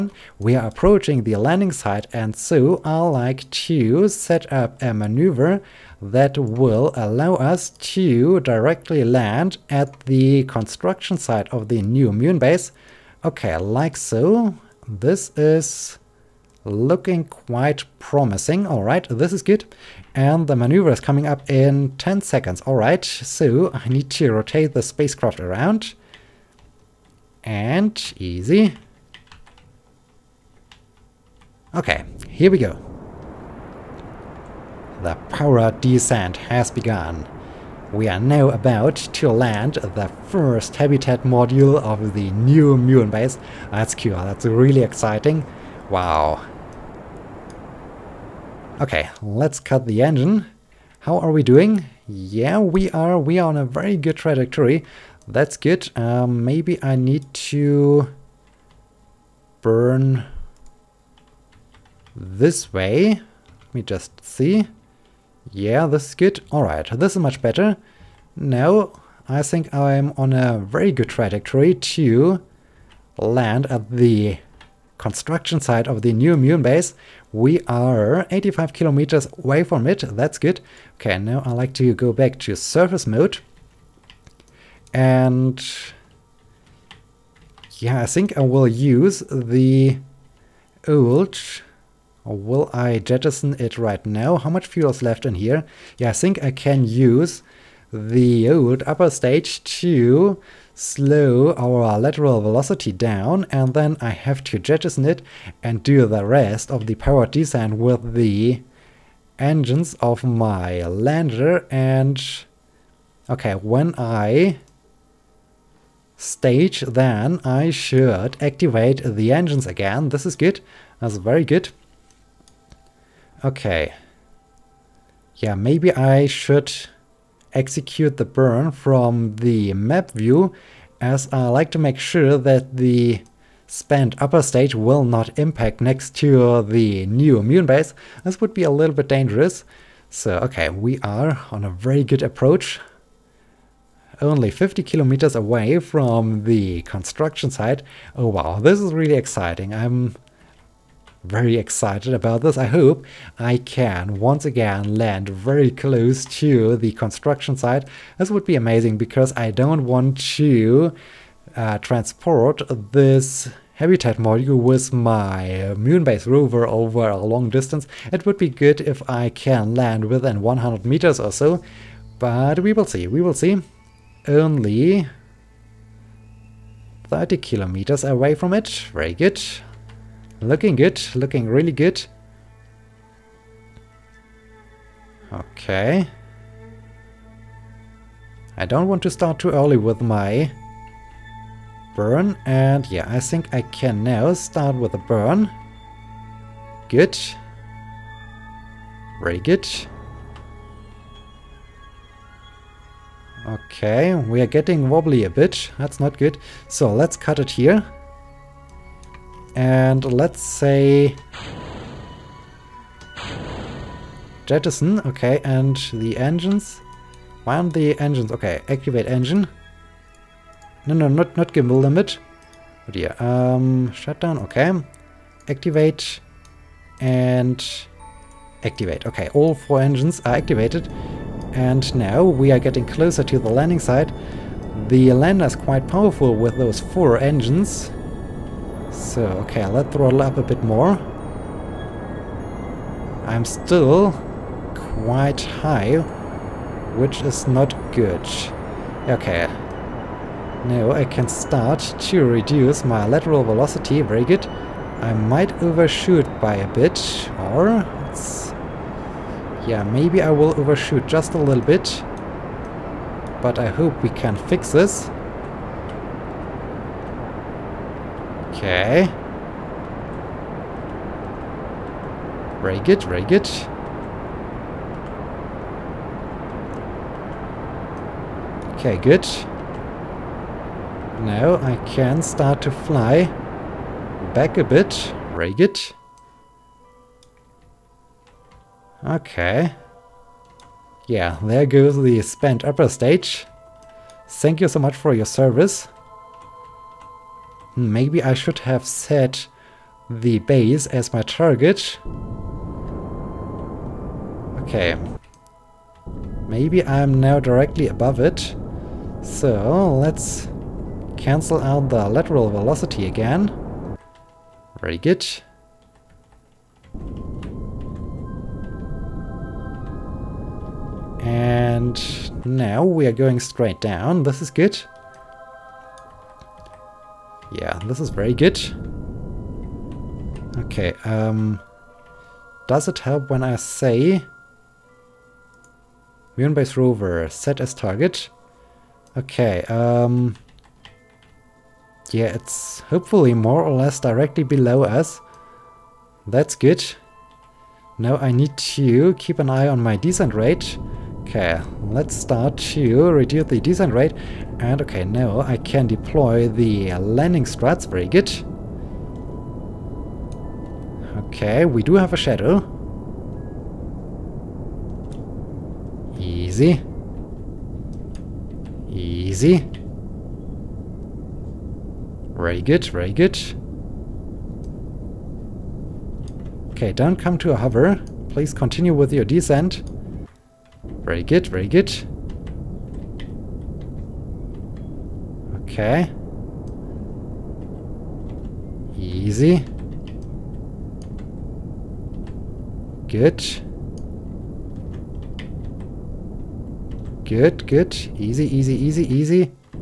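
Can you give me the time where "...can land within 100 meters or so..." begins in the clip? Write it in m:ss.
2:49.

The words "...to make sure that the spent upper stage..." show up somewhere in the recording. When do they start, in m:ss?
2:11.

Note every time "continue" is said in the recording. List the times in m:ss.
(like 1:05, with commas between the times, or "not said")
6:18.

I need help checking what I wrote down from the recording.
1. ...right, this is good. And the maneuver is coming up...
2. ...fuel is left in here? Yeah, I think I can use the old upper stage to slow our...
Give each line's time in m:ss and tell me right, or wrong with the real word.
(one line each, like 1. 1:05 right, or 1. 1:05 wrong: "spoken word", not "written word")
1. 0:18 right
2. 1:34 right.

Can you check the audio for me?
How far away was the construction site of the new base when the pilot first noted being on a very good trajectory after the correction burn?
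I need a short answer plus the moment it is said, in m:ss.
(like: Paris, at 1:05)
85 kilometers, at 1:18.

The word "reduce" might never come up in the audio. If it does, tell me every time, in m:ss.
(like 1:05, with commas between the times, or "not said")
4:12, 5:53.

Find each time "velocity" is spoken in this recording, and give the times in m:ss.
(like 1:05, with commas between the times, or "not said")
1:42, 4:13, 5:12.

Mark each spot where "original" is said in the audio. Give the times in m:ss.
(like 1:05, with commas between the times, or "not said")
not said.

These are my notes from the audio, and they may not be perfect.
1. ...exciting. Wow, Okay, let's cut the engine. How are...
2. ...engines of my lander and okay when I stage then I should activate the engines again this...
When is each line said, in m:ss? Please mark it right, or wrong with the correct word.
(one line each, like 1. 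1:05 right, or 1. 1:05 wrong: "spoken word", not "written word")
1. 0:44 right
2. 1:49 right.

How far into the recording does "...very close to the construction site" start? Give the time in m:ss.
2:35.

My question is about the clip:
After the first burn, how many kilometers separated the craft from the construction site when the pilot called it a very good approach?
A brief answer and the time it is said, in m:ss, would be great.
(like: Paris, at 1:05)
50 kilometers, at 2:24.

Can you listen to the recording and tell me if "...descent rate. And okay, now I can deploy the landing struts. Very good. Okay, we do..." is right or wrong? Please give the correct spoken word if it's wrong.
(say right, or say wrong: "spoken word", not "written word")
right.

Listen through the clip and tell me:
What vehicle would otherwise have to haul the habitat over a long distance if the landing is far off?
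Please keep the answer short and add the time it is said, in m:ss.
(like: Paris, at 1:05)
moonbase rover, at 2:45.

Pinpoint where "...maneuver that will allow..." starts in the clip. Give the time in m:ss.
0:04.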